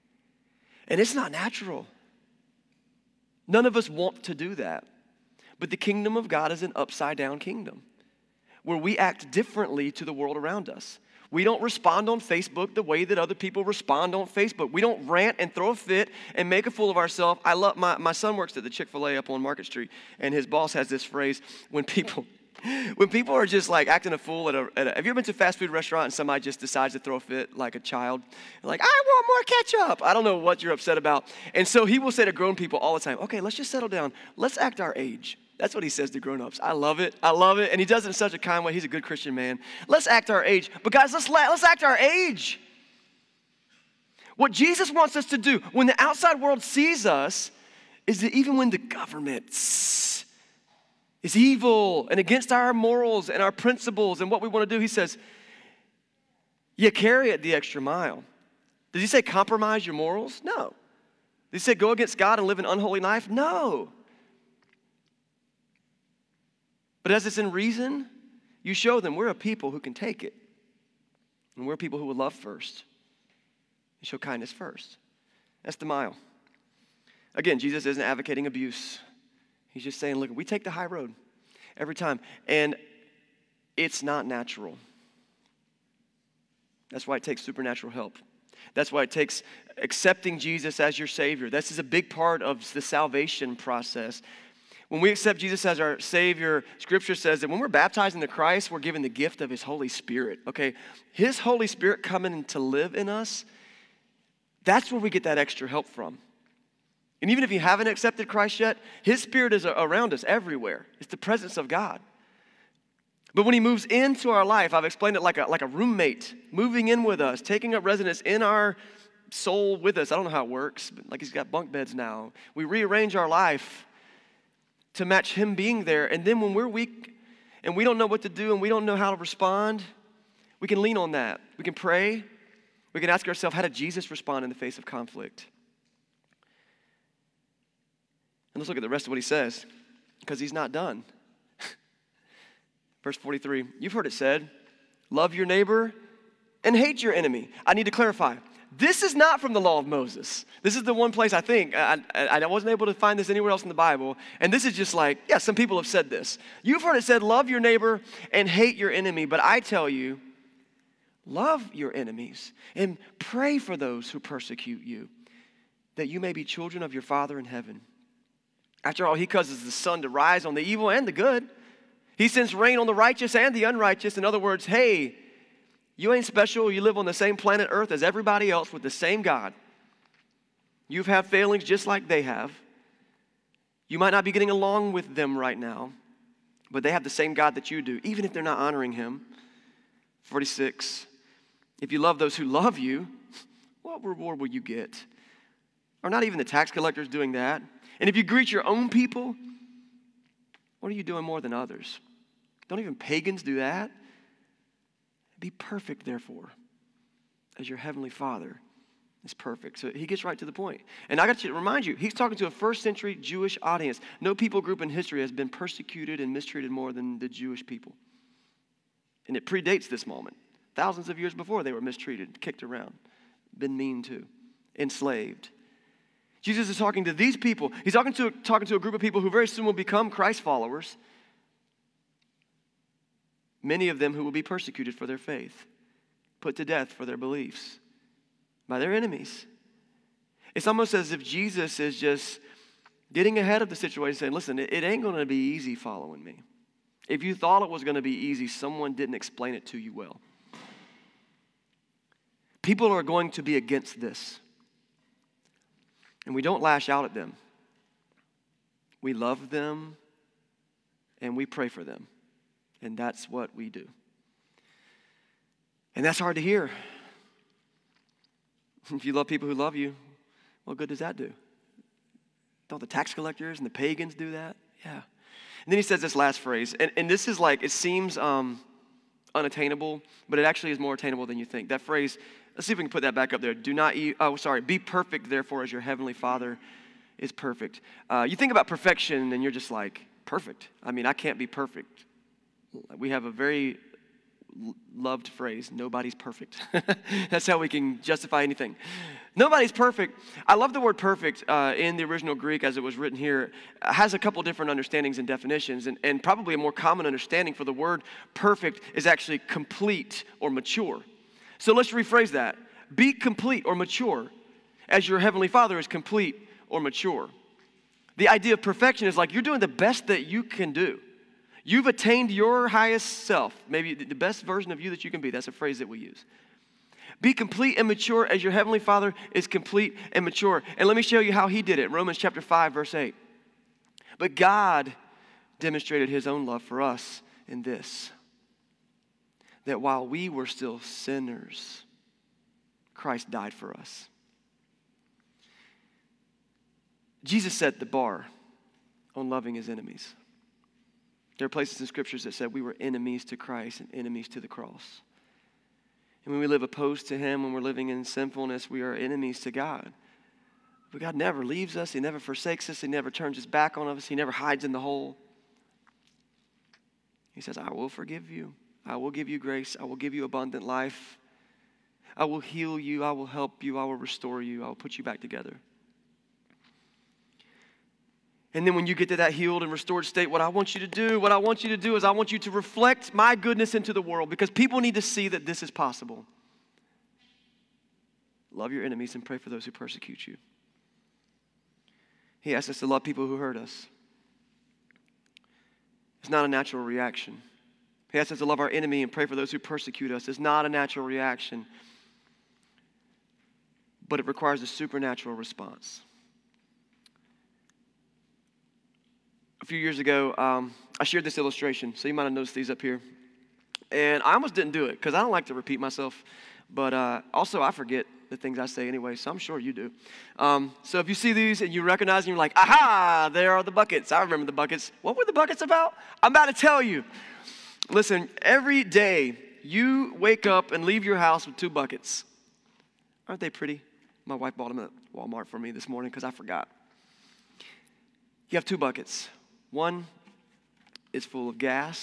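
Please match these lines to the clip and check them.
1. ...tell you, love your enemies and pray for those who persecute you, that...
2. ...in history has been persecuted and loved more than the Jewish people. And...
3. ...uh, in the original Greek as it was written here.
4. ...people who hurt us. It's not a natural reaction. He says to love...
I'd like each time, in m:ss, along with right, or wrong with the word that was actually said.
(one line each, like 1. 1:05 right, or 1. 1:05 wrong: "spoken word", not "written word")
1. 2:39 right
2. 3:34 wrong: "mistreated", not "loved"
3. 5:01 right
4. 6:33 right.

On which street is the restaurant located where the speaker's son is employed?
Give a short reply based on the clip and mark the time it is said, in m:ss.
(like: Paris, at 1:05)
Market Street, at 0:19.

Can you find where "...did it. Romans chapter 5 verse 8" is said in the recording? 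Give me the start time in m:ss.
5:31.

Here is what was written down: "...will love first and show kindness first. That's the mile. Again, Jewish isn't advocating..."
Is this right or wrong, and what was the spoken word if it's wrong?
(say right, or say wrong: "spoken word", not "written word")
wrong: "Jesus", not "Jewish".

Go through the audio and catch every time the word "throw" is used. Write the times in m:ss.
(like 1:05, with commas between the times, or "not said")
0:15, 0:26.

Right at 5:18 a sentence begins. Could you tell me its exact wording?
The idea of perfection is like you're doing the best that you can do.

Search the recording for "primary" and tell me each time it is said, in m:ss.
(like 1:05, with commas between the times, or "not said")
not said.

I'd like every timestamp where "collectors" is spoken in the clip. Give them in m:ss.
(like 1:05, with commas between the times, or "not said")
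3:16, 4:33.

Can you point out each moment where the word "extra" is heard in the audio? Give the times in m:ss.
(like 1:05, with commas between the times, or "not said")
0:57, 1:45.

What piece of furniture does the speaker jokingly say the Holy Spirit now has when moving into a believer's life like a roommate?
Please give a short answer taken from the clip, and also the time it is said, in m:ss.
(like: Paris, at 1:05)
Bunk beds, at 2:01.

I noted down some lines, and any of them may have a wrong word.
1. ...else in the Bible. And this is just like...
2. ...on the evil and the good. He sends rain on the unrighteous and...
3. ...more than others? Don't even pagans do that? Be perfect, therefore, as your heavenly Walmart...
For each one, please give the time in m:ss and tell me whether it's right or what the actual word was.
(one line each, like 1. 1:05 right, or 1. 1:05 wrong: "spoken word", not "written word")
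1. 2:33 right
2. 2:50 wrong: "righteous", not "unrighteous"
3. 3:21 wrong: "Father", not "Walmart".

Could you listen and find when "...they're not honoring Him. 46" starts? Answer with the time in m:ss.
3:08.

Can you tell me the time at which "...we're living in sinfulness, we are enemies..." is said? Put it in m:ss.
5:57.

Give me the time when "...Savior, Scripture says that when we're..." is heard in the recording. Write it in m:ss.
1:35.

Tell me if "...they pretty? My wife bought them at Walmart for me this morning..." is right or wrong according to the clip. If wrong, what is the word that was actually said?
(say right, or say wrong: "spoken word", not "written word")
right.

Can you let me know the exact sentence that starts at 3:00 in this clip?
You've had failings just like they have.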